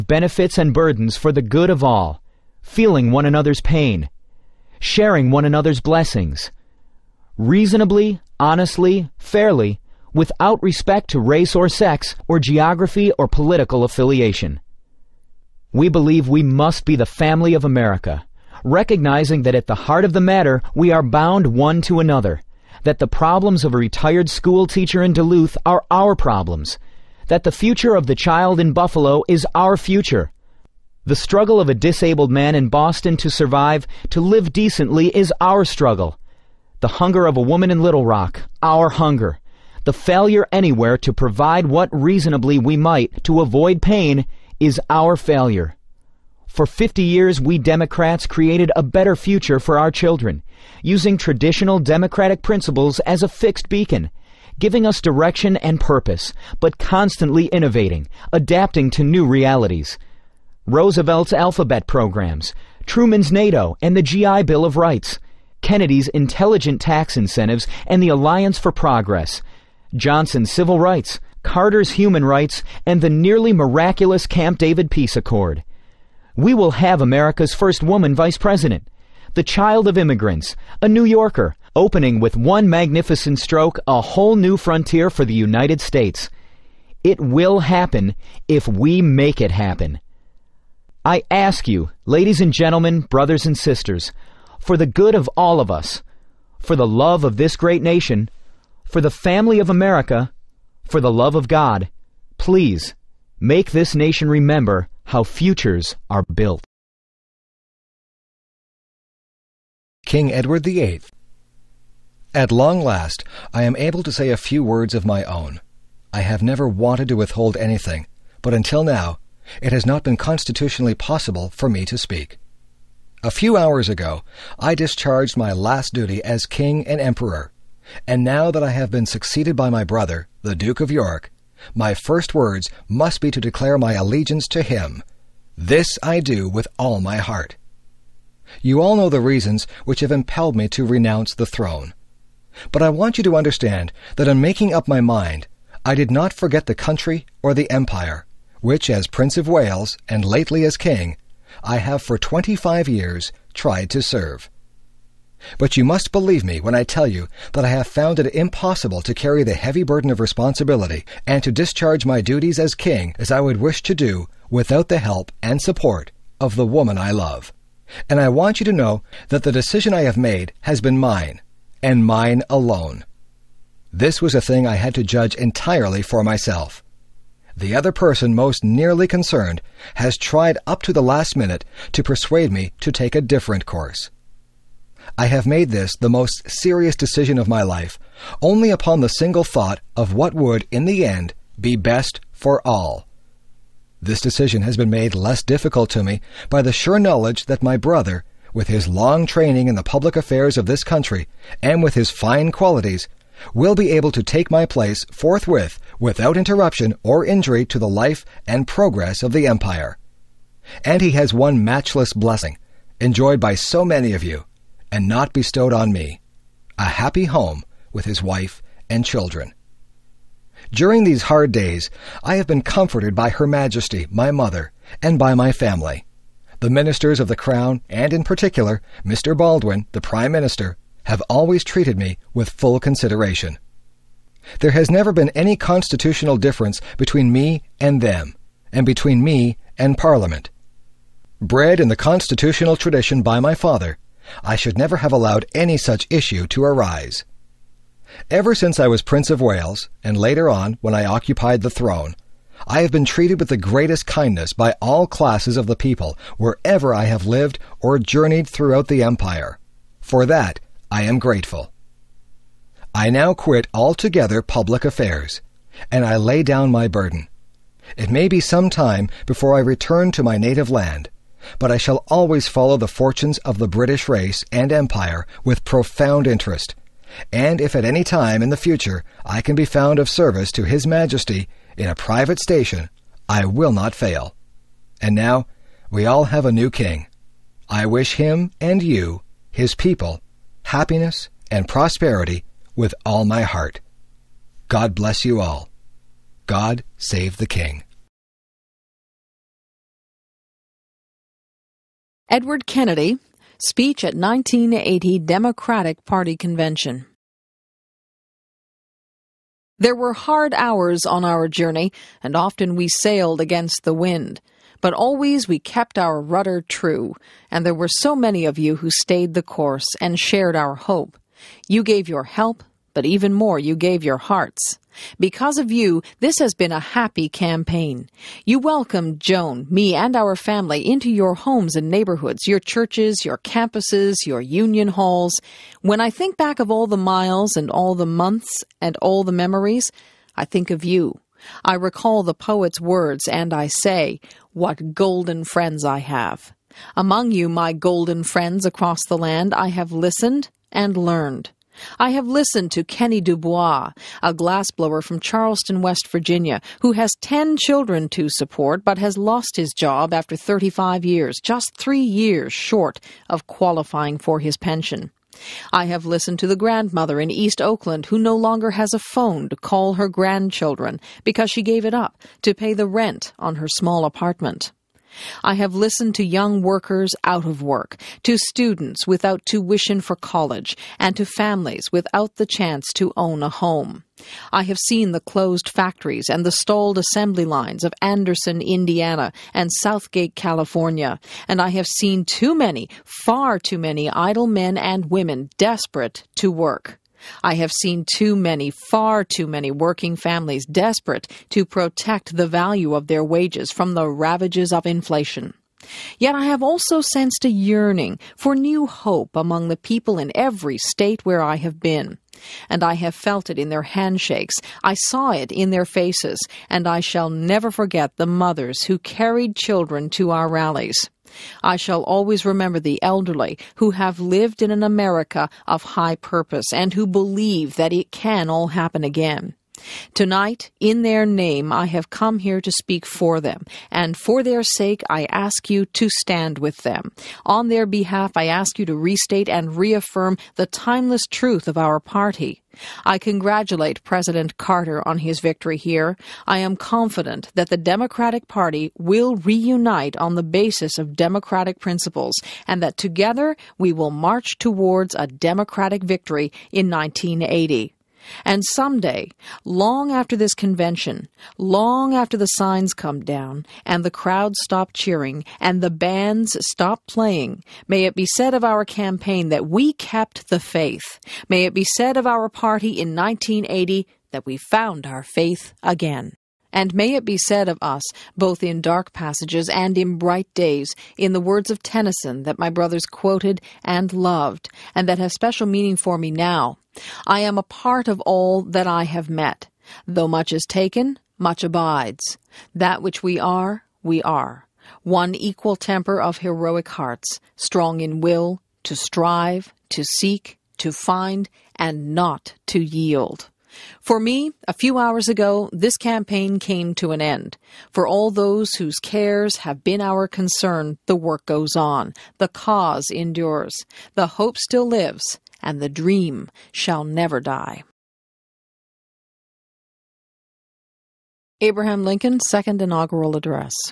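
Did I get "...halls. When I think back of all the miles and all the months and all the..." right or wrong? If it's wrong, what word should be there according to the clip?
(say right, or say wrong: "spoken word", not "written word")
right.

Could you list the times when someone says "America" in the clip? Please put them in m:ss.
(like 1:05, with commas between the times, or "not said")
0:17, 1:17, 1:39, 7:04.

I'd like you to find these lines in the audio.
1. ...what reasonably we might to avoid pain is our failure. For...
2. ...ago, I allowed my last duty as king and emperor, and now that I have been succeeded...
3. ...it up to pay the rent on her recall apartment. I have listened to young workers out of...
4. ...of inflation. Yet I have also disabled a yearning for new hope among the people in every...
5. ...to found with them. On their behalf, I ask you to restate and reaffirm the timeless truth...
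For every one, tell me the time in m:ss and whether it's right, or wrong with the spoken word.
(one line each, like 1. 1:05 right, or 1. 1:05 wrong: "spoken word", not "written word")
1. 0:41 right
2. 2:03 wrong: "discharged", not "allowed"
3. 6:11 wrong: "small", not "recall"
4. 6:44 wrong: "sensed", not "disabled"
5. 7:15 wrong: "stand", not "found".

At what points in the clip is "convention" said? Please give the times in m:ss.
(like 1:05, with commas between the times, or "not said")
5:06, 7:40.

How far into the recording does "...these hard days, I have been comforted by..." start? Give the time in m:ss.
3:41.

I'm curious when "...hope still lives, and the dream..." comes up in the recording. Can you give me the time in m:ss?
8:34.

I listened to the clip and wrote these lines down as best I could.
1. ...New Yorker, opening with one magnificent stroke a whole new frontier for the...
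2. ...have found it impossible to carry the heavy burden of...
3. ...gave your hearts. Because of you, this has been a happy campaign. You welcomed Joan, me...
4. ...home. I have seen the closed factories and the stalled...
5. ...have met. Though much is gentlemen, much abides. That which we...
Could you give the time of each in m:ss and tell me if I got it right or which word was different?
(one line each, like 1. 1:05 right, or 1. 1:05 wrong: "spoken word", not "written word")
1. 1:20 right
2. 2:37 right
3. 5:23 right
4. 6:23 right
5. 8:09 wrong: "taken", not "gentlemen".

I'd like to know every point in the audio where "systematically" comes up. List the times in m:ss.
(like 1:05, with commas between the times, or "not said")
not said.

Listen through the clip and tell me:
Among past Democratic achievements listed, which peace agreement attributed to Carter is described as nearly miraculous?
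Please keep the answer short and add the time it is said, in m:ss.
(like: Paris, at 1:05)
Camp David Peace Accord, at 1:14.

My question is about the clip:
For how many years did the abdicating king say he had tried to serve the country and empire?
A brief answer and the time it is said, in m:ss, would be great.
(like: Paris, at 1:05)
25, at 2:32.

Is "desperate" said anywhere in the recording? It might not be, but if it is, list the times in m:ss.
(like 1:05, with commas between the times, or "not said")
6:35, 6:40.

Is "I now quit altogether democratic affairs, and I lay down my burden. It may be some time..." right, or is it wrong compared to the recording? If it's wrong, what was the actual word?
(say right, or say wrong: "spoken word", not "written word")
wrong: "public", not "democratic".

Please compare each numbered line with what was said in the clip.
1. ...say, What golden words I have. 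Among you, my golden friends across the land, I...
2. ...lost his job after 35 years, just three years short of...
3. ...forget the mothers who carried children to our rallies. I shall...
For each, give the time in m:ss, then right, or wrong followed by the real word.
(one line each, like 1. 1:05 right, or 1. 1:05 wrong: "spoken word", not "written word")
1. 5:43 wrong: "friends", not "words"
2. 5:59 right
3. 6:57 right.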